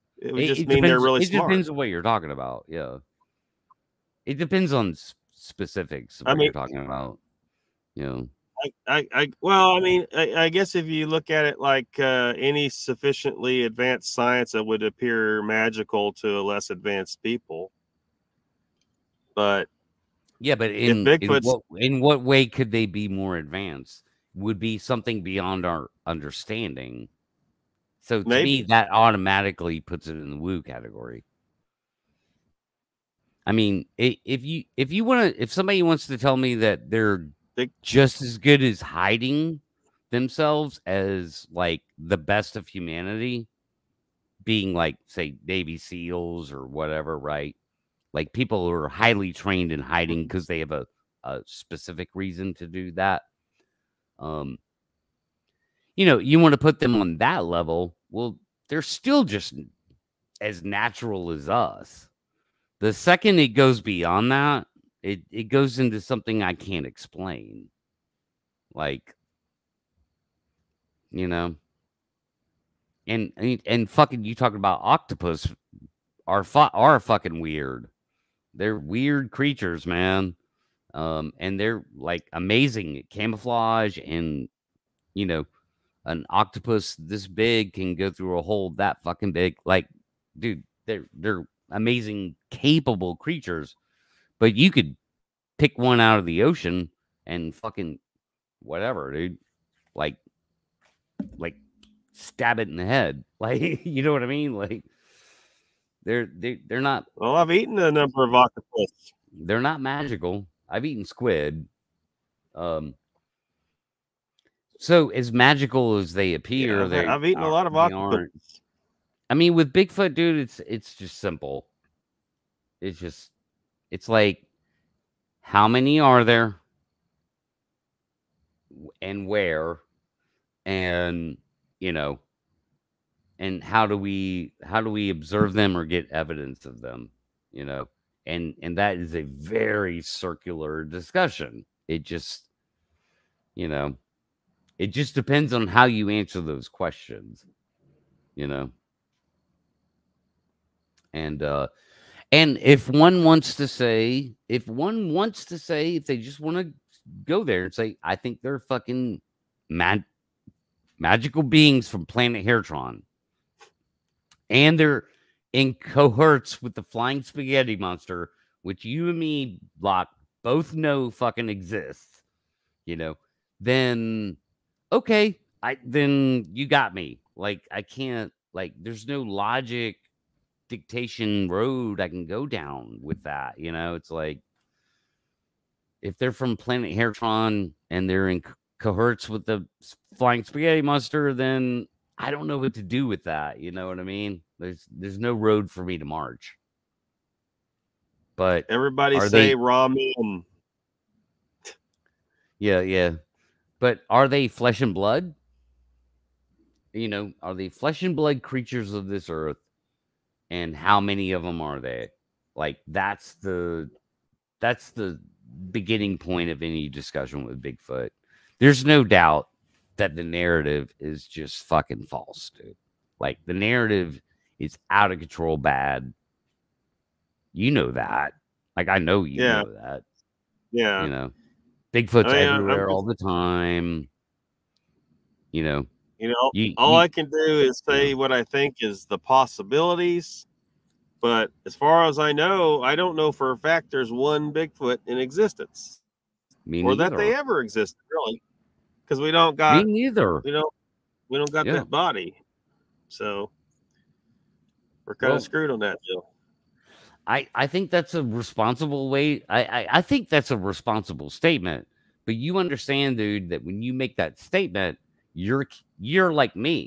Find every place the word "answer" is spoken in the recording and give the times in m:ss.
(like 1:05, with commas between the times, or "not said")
2:26.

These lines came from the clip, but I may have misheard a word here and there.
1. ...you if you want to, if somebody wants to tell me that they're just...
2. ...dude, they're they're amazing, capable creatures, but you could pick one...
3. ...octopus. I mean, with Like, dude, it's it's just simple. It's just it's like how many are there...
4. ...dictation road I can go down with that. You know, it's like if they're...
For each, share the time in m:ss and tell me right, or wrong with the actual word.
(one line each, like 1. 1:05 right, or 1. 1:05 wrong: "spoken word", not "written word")
1. 0:34 right
2. 1:30 right
3. 1:57 wrong: "Bigfoot", not "Like"
4. 3:00 right.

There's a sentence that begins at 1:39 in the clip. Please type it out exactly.
Like, like stab it in the head.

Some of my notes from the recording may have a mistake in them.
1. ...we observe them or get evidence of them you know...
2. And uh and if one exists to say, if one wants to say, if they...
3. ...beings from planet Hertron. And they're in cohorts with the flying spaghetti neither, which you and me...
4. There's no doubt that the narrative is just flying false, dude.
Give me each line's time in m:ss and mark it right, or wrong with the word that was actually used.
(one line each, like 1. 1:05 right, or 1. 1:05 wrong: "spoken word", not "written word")
1. 2:14 right
2. 2:31 wrong: "wants", not "exists"
3. 2:41 wrong: "monster", not "neither"
4. 3:38 wrong: "fucking", not "flying".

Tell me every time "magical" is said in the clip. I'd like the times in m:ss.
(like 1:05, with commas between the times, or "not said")
0:15, 1:49, 1:55, 2:40.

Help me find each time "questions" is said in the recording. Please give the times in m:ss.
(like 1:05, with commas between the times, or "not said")
2:26.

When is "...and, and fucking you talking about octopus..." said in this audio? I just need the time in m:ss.
1:13.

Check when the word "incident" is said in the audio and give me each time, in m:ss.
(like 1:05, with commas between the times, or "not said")
not said.